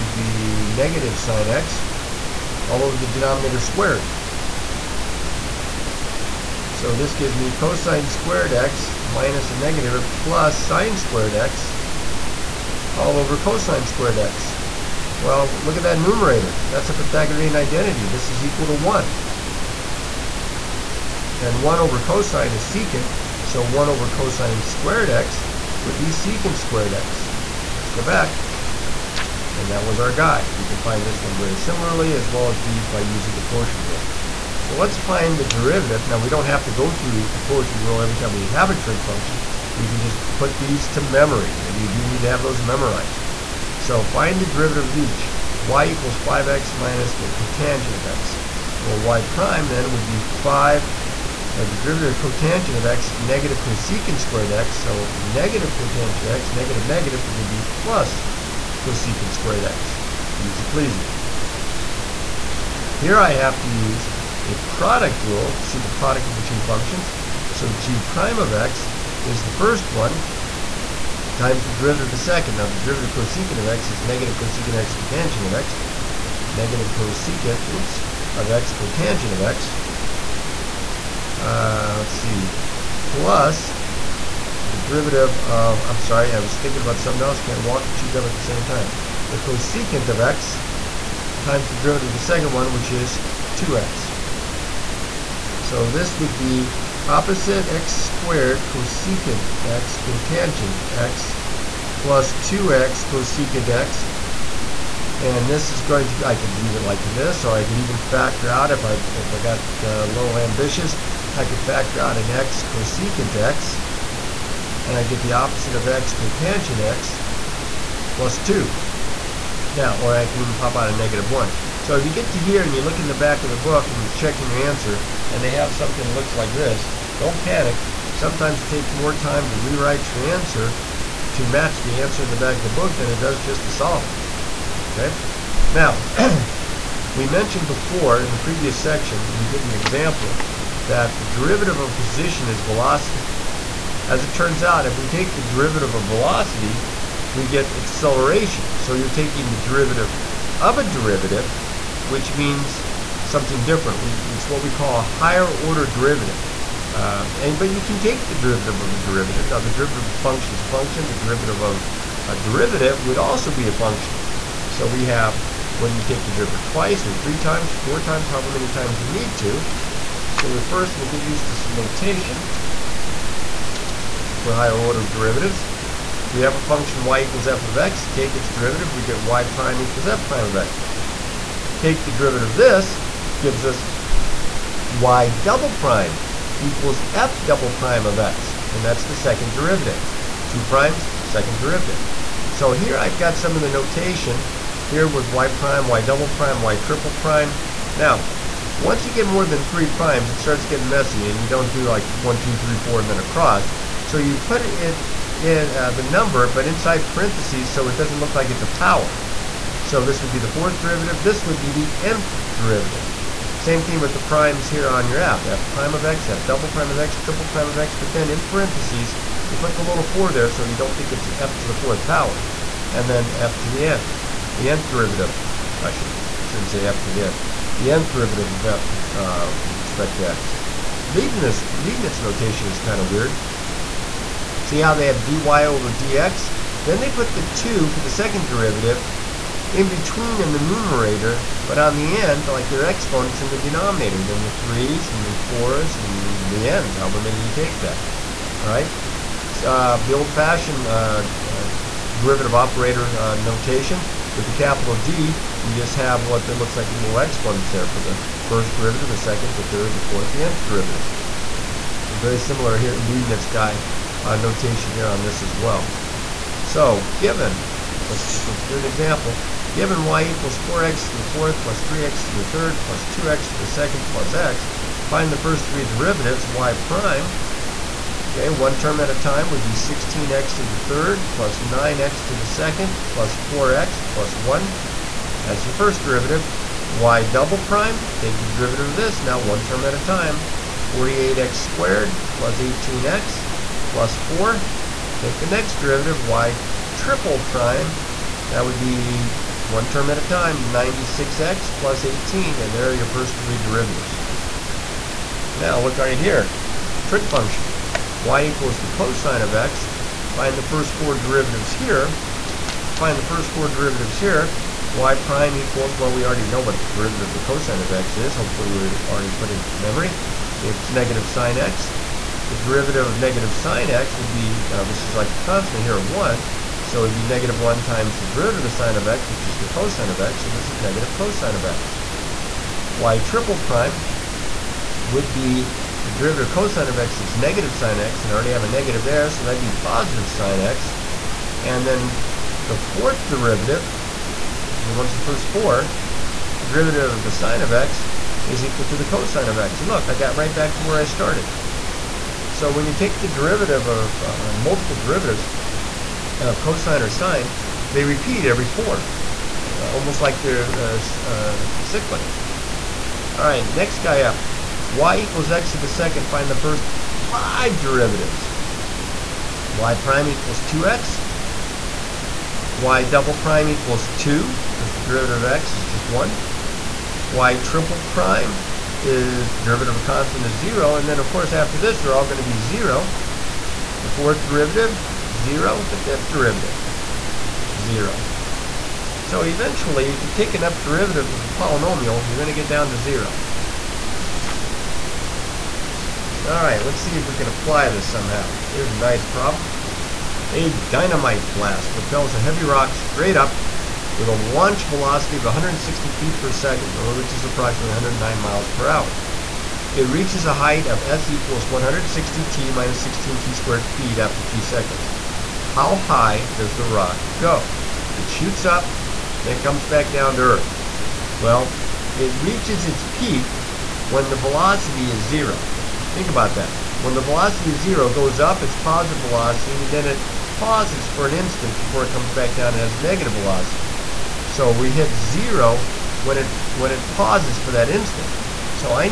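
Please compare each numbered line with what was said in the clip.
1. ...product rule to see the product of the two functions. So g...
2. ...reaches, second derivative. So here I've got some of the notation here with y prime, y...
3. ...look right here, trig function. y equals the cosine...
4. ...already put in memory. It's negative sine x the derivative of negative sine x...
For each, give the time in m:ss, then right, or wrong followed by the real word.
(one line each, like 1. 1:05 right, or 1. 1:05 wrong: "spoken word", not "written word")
1. 1:04 right
2. 3:10 wrong: "primes", not "reaches"
3. 5:05 right
4. 5:19 right.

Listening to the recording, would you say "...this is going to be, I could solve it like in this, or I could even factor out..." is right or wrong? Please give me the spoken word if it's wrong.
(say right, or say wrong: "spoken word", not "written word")
wrong: "leave", not "solve".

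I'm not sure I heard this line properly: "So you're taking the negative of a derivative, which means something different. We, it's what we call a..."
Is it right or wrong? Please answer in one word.
wrong.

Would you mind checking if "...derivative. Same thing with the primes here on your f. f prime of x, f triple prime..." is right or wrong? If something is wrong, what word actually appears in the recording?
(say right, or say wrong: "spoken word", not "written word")
wrong: "double", not "triple".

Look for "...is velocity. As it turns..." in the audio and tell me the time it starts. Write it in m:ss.
2:22.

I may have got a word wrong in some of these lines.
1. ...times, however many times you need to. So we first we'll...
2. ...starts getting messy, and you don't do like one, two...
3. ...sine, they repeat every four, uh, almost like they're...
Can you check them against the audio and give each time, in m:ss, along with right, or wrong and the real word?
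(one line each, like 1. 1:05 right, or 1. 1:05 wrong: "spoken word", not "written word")
1. 2:47 right
2. 3:20 right
3. 5:57 right.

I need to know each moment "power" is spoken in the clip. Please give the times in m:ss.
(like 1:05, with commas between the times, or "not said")
3:28, 3:42.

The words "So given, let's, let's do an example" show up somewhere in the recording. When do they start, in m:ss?
4:26.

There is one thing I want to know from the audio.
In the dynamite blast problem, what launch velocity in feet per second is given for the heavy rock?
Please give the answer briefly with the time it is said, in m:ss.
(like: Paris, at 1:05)
160 feet per second, at 6:45.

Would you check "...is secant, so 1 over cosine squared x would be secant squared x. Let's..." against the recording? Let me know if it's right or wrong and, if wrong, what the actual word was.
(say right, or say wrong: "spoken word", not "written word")
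right.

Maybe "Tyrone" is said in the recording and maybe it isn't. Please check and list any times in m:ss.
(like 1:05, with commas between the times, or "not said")
not said.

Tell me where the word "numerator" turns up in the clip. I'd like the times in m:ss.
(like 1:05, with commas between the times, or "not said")
0:15, 4:00.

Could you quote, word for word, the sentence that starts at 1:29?
The cosecant of x times the derivative of the second one, which is 2x.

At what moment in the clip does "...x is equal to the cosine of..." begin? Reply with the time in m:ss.
5:47.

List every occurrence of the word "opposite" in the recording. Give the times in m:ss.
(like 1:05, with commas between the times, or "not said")
1:37, 1:55.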